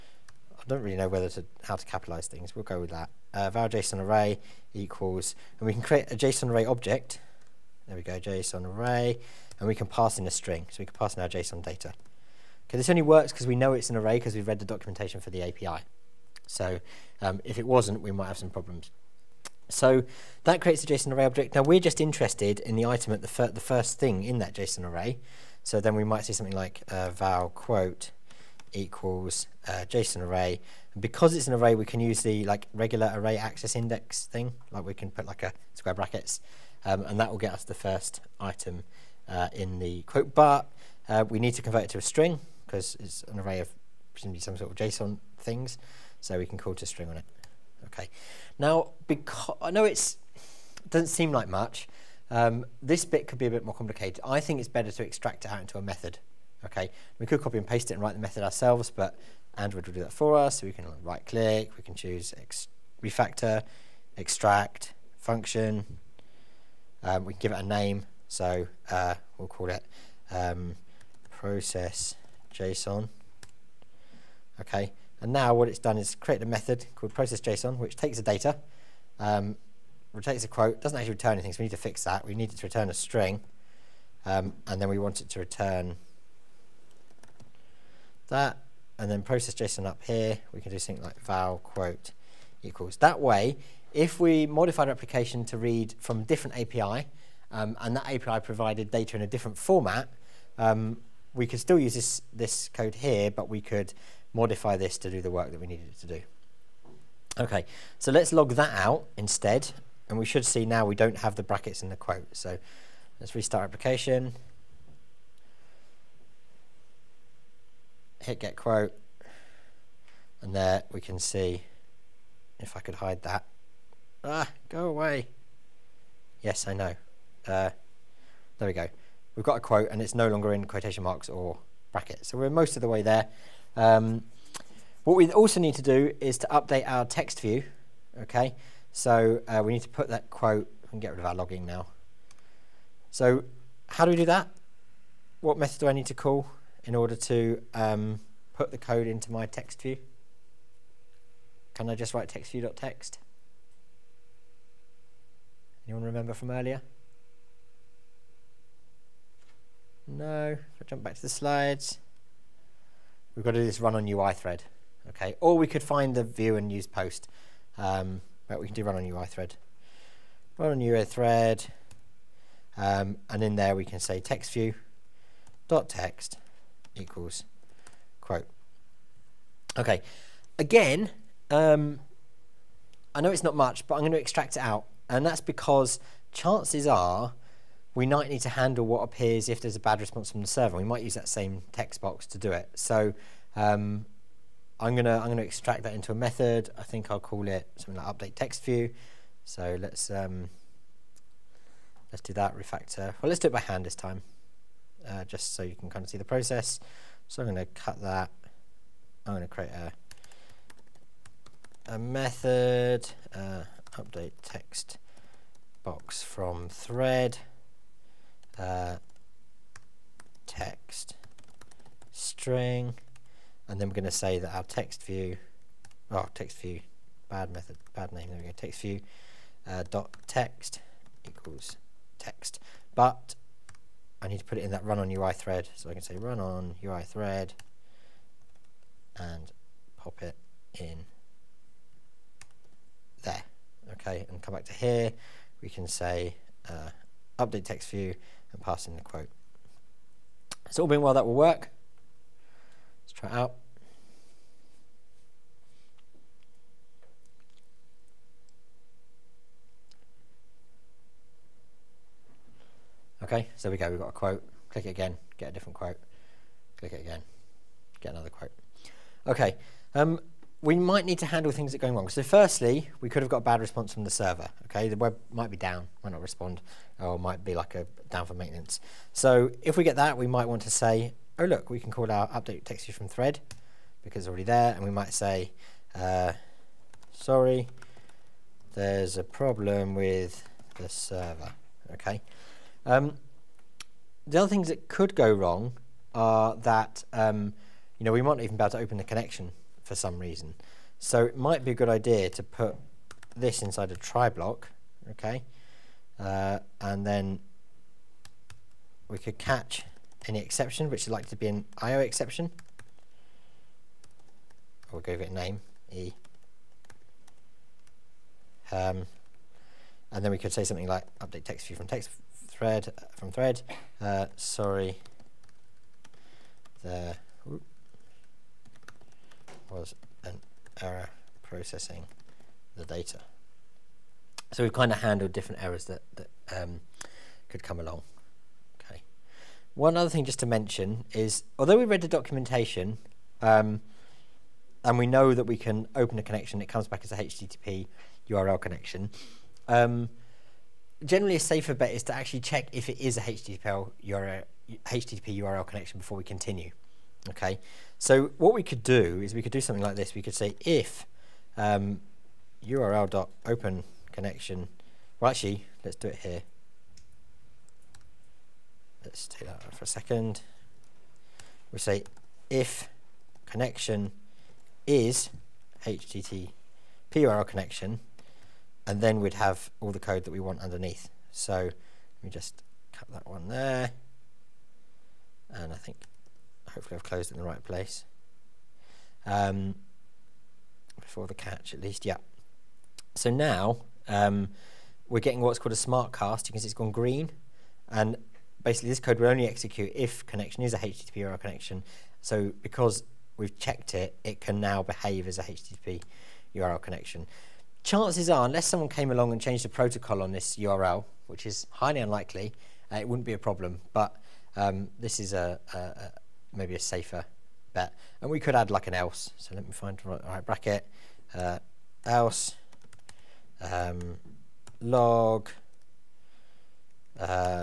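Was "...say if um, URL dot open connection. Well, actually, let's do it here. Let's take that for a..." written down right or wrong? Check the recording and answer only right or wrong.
right.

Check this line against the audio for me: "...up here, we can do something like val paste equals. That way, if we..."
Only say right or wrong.
wrong.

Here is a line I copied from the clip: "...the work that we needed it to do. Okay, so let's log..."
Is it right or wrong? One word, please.
right.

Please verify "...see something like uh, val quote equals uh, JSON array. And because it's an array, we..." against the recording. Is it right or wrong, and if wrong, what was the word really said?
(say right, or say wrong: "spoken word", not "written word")
right.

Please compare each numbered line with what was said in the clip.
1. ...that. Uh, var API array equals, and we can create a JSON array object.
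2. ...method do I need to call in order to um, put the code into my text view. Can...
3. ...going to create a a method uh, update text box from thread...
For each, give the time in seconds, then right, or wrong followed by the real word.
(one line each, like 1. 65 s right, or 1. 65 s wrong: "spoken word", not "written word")
1. 2 s wrong: "JSON", not "API"
2. 145 s right
3. 209 s right.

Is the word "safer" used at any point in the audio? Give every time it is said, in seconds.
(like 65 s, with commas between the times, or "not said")
351 s, 416 s.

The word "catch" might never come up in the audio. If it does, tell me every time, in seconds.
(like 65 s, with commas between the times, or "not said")
309 s, 391 s.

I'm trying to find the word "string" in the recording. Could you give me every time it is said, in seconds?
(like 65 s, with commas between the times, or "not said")
10 s, 42 s, 46 s, 82 s, 222 s.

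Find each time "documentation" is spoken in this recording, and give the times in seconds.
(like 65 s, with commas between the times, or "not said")
14 s, 342 s.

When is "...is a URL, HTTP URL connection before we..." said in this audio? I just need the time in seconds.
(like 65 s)
352 s.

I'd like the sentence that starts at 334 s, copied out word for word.
So we've kind of handled different errors that, that um, could come along.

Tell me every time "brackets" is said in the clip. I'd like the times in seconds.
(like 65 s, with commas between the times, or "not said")
35 s, 111 s, 131 s, 420 s.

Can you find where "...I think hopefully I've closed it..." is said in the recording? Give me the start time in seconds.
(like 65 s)
385 s.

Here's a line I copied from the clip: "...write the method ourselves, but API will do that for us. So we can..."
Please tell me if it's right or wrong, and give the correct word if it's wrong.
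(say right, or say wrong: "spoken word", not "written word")
wrong: "Android", not "API".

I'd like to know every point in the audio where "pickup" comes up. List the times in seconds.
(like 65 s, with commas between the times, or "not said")
not said.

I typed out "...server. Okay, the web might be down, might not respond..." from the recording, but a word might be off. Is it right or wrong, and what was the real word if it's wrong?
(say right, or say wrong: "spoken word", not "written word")
right.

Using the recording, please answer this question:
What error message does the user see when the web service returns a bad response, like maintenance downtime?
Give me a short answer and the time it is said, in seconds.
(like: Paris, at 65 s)
sorry, there's a problem with the server, at 287 s.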